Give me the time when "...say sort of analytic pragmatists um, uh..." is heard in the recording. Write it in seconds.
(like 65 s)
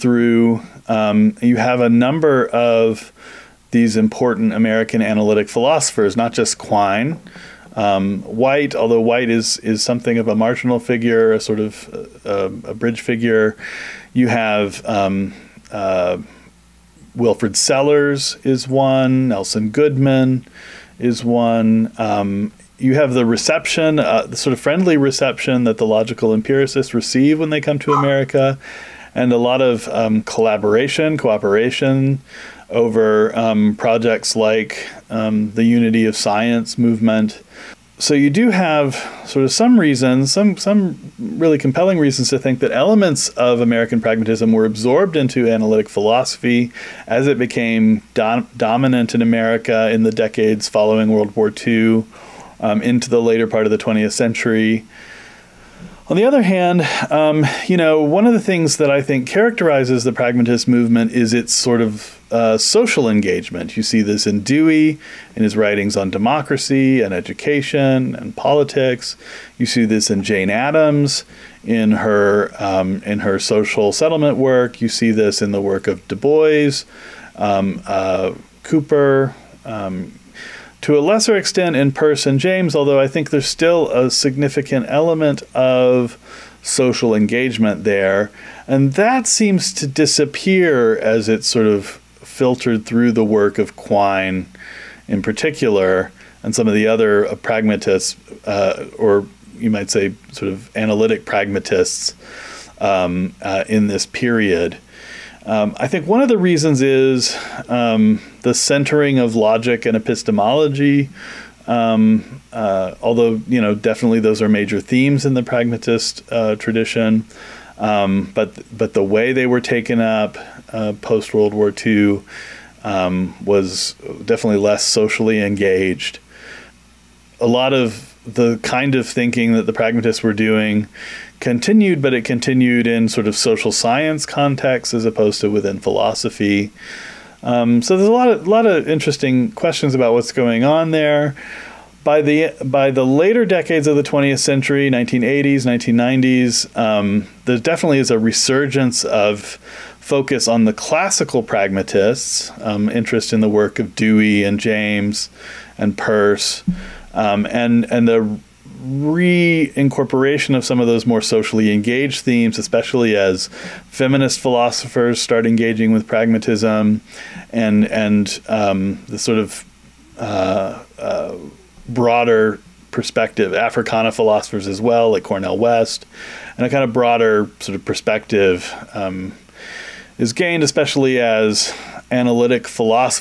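99 s.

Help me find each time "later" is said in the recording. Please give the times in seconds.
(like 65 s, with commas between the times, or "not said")
53 s, 143 s.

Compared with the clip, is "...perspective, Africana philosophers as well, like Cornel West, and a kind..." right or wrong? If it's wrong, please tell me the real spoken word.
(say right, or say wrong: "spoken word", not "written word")
right.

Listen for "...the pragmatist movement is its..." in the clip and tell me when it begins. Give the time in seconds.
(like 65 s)
60 s.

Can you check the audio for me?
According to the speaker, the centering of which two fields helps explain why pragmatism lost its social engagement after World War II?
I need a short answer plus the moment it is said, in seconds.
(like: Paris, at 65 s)
logic and epistemology, at 109 s.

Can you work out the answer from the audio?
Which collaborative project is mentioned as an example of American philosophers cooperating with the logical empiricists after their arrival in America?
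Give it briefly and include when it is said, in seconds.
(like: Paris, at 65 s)
Unity of Science movement, at 35 s.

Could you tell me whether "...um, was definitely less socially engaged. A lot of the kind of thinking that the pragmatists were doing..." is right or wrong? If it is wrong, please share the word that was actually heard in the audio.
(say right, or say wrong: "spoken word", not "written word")
right.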